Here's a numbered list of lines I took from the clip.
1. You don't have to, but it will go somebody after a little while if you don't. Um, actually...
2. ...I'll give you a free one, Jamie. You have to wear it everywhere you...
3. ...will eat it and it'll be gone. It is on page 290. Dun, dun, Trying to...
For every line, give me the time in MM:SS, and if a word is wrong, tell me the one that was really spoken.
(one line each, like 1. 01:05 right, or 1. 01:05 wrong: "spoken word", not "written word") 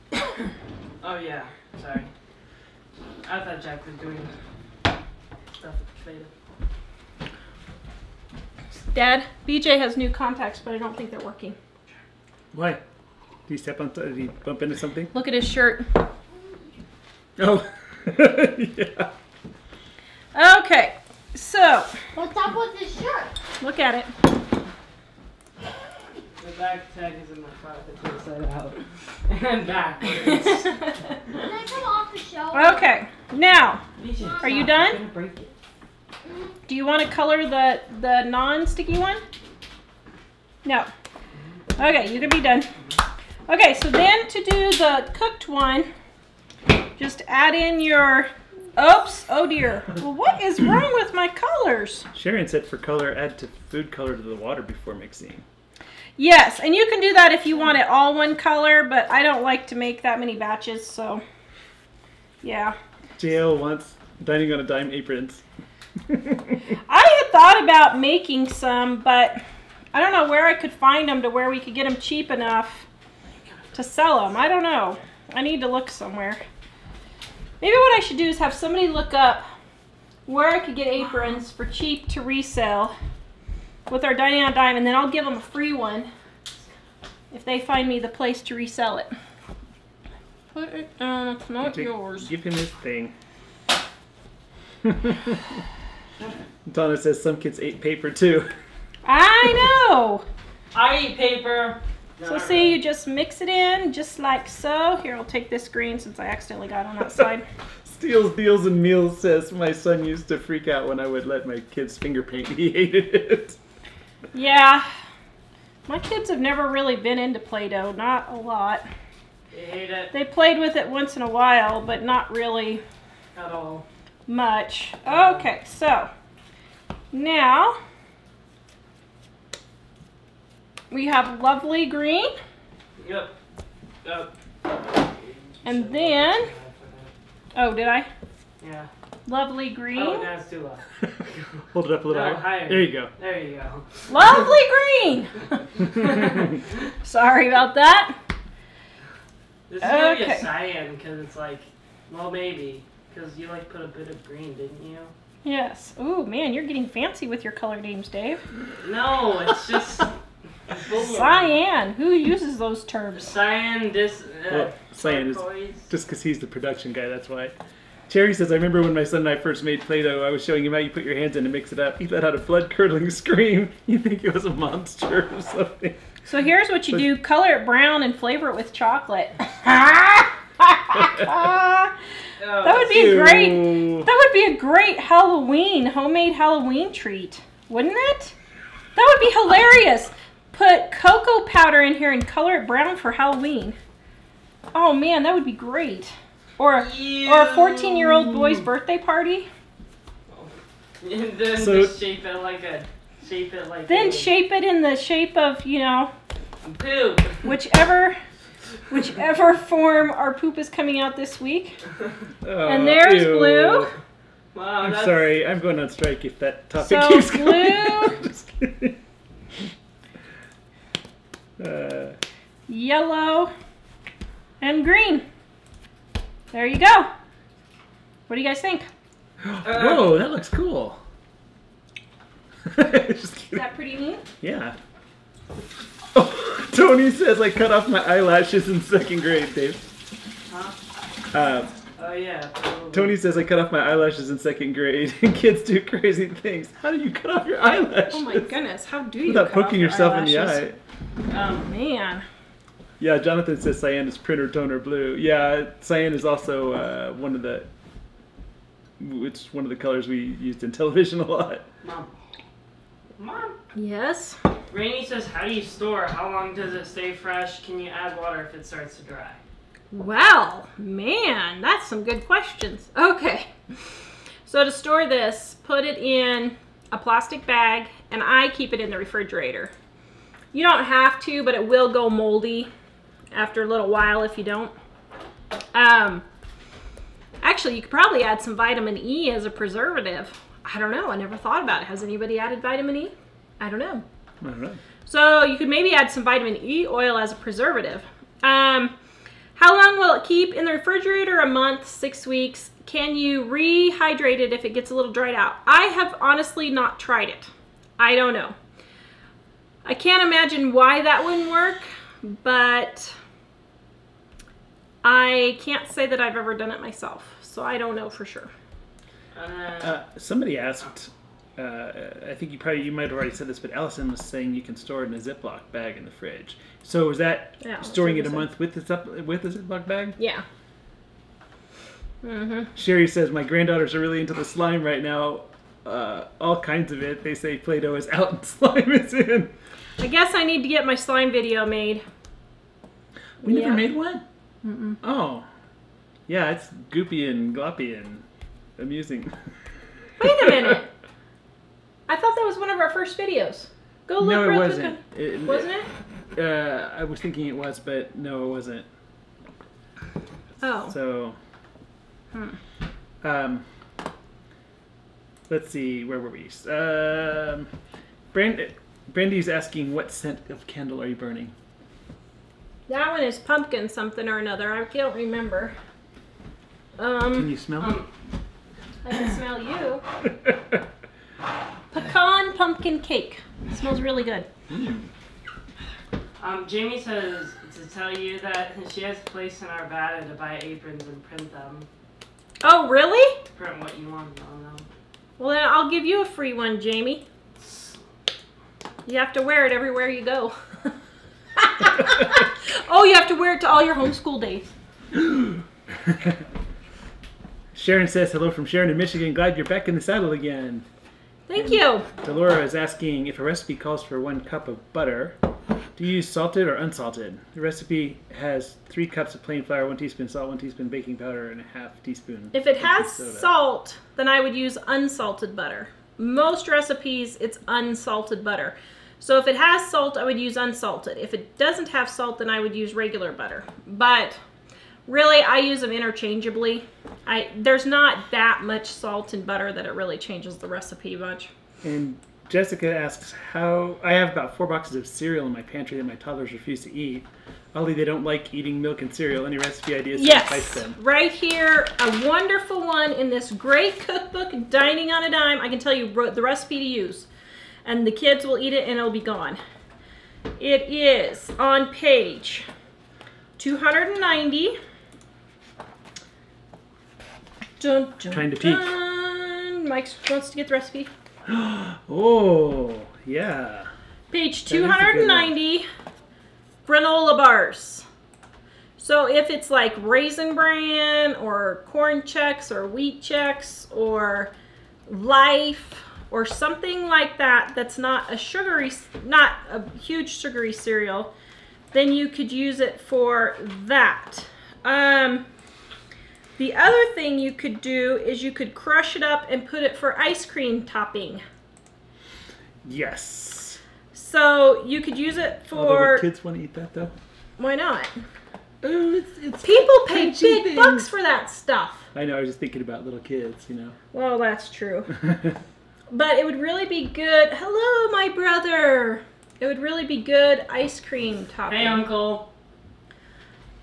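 1. 04:40 wrong: "moldy", not "somebody"
2. 06:35 right
3. 07:38 right.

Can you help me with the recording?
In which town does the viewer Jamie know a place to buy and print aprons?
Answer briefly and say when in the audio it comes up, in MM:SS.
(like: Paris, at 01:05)
Arvada, at 06:29.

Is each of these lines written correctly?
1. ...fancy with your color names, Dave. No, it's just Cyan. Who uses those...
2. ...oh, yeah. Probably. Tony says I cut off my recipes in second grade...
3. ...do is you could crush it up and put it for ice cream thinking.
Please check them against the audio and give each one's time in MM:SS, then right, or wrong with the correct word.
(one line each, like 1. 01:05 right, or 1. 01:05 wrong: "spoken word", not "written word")
1. 02:36 right
2. 04:02 wrong: "eyelashes", not "recipes"
3. 08:17 wrong: "topping", not "thinking".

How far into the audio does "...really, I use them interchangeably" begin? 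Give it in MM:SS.
07:15.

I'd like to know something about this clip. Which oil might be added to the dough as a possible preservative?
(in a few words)
vitamin E oil.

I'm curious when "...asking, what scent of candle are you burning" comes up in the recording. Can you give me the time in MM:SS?
06:09.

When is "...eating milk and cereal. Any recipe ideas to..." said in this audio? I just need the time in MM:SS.
07:28.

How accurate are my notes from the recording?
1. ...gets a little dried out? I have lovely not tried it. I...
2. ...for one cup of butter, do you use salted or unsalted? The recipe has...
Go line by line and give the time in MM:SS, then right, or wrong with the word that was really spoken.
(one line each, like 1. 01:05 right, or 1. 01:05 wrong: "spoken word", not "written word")
1. 05:04 wrong: "honestly", not "lovely"
2. 06:54 right.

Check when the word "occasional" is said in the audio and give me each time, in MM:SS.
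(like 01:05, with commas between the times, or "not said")
not said.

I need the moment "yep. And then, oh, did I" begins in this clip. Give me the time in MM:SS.
02:14.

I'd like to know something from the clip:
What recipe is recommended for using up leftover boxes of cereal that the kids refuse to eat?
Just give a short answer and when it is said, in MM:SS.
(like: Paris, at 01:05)
granola bars, at 07:56.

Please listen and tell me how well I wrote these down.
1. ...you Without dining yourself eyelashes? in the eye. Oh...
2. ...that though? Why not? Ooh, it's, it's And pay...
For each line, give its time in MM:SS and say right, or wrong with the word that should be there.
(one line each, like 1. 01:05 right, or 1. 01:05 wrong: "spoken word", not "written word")
1. 04:09 wrong: "poking", not "dining"
2. 08:26 wrong: "People", not "And".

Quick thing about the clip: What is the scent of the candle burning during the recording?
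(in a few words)
Pecan pumpkin cake.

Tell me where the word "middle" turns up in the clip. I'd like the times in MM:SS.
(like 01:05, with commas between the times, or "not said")
not said.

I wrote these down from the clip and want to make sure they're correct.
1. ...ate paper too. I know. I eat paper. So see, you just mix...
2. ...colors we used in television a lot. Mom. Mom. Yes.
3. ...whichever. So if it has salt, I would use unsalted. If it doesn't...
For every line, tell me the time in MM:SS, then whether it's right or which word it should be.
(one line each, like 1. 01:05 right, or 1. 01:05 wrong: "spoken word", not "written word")
1. 01:37 right
2. 04:19 right
3. 07:08 wrong: "butter", not "whichever".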